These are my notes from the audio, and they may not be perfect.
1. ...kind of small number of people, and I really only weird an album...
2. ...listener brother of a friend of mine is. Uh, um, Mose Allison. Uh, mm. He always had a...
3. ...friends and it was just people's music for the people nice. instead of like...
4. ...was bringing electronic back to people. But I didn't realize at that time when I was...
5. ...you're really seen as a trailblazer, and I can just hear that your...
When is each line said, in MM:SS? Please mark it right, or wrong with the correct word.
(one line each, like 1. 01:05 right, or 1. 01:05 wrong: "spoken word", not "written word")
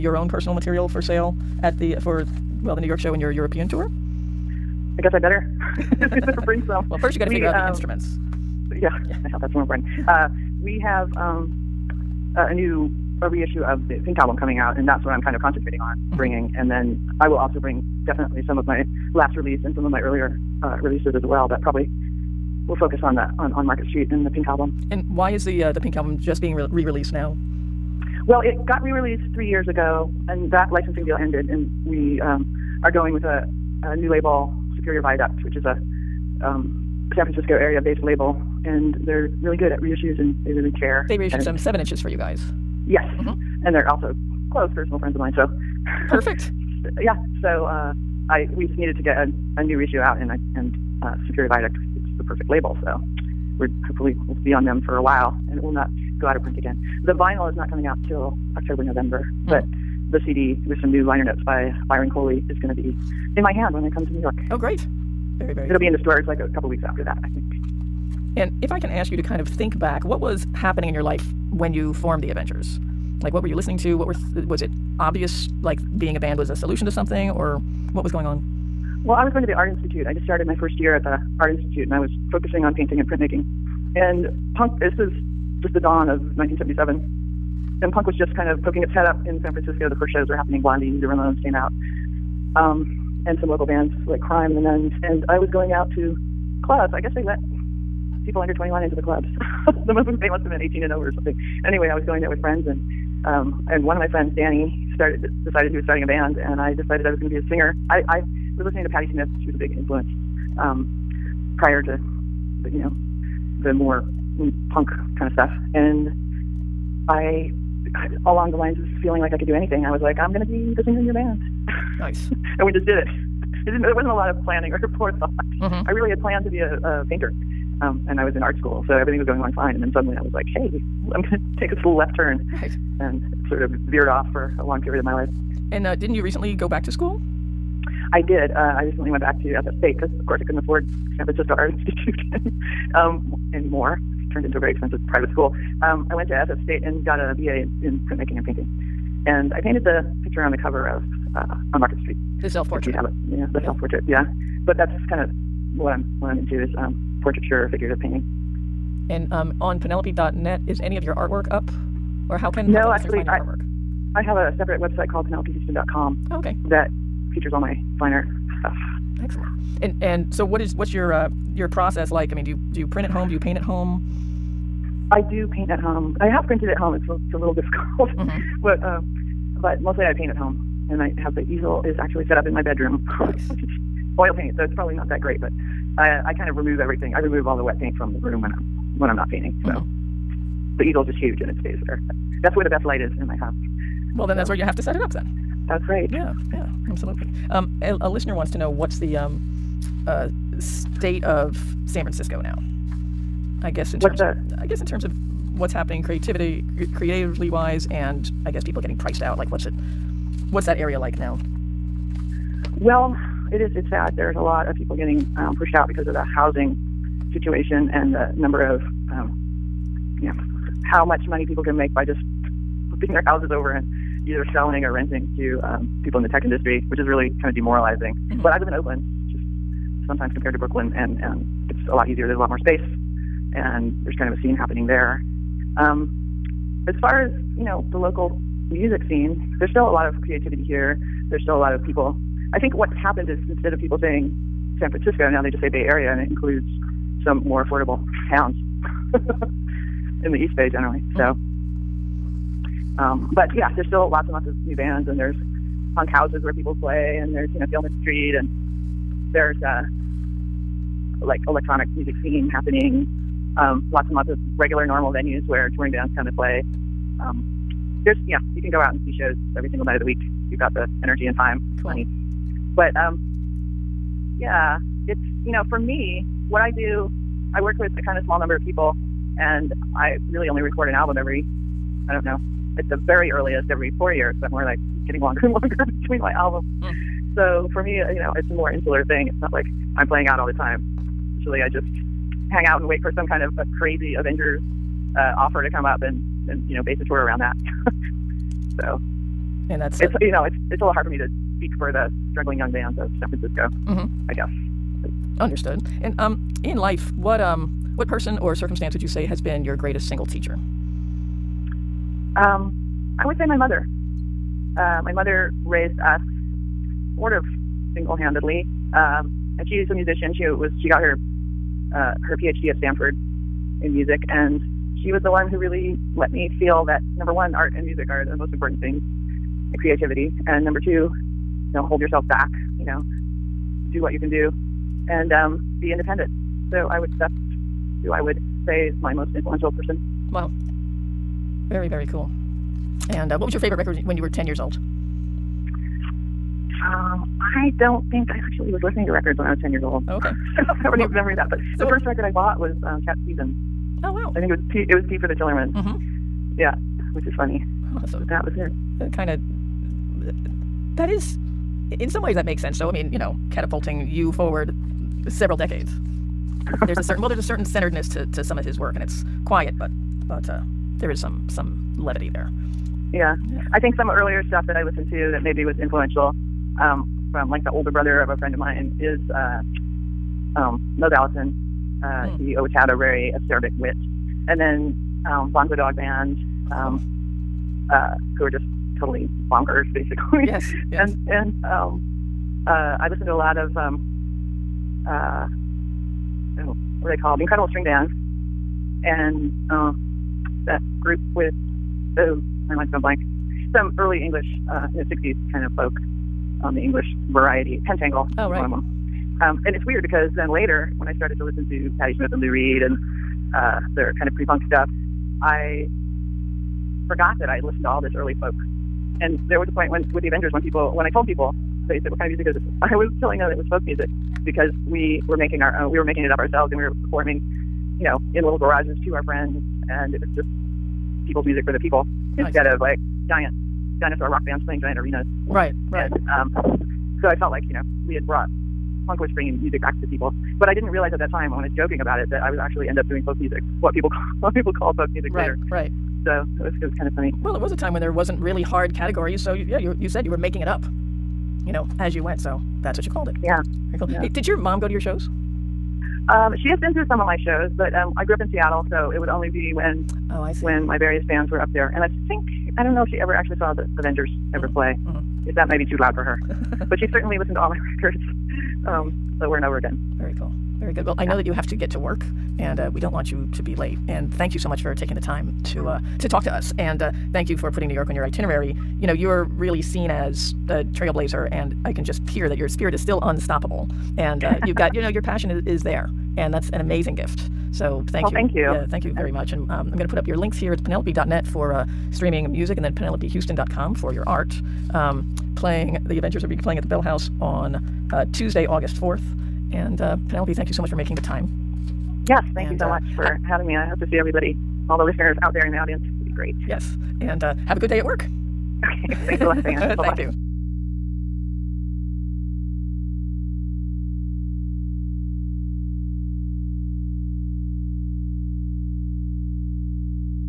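1. 04:38 wrong: "record", not "weird"
2. 06:17 wrong: "older", not "listener"
3. 07:09 right
4. 07:19 wrong: "music", not "electronic"
5. 07:59 right.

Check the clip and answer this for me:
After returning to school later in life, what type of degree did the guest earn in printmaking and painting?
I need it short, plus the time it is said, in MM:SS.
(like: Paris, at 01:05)
BA, at 02:27.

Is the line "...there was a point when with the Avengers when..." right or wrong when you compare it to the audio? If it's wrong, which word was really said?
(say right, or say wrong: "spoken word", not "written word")
right.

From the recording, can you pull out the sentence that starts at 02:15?
And uh, didn't you recently go back to school?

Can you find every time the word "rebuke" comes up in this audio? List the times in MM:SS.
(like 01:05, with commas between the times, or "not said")
not said.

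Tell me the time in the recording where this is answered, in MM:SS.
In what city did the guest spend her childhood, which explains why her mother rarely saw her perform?
07:38.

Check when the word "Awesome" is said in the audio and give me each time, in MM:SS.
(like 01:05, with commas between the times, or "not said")
05:58.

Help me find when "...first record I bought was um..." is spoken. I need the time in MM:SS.
05:51.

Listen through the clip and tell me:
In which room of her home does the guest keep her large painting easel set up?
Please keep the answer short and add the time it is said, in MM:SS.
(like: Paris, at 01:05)
Bedroom, at 03:02.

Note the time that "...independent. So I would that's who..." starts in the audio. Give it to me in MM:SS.
05:35.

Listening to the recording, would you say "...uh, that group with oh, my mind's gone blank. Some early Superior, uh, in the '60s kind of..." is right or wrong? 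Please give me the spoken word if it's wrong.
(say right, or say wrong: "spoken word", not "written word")
wrong: "English", not "Superior".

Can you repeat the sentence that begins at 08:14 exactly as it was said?
Um, playing, the Avengers are be playing at the Bell House on uh, Tuesday, August 4th.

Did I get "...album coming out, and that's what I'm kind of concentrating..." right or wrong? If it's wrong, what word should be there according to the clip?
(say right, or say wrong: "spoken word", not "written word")
right.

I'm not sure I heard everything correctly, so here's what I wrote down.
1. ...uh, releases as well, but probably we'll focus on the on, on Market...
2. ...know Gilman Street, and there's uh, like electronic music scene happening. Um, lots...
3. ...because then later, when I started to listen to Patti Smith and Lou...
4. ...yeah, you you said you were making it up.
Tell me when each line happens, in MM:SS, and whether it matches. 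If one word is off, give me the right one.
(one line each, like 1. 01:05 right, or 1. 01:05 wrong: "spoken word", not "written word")
1. 00:20 right
2. 04:17 right
3. 06:50 right
4. 07:29 right.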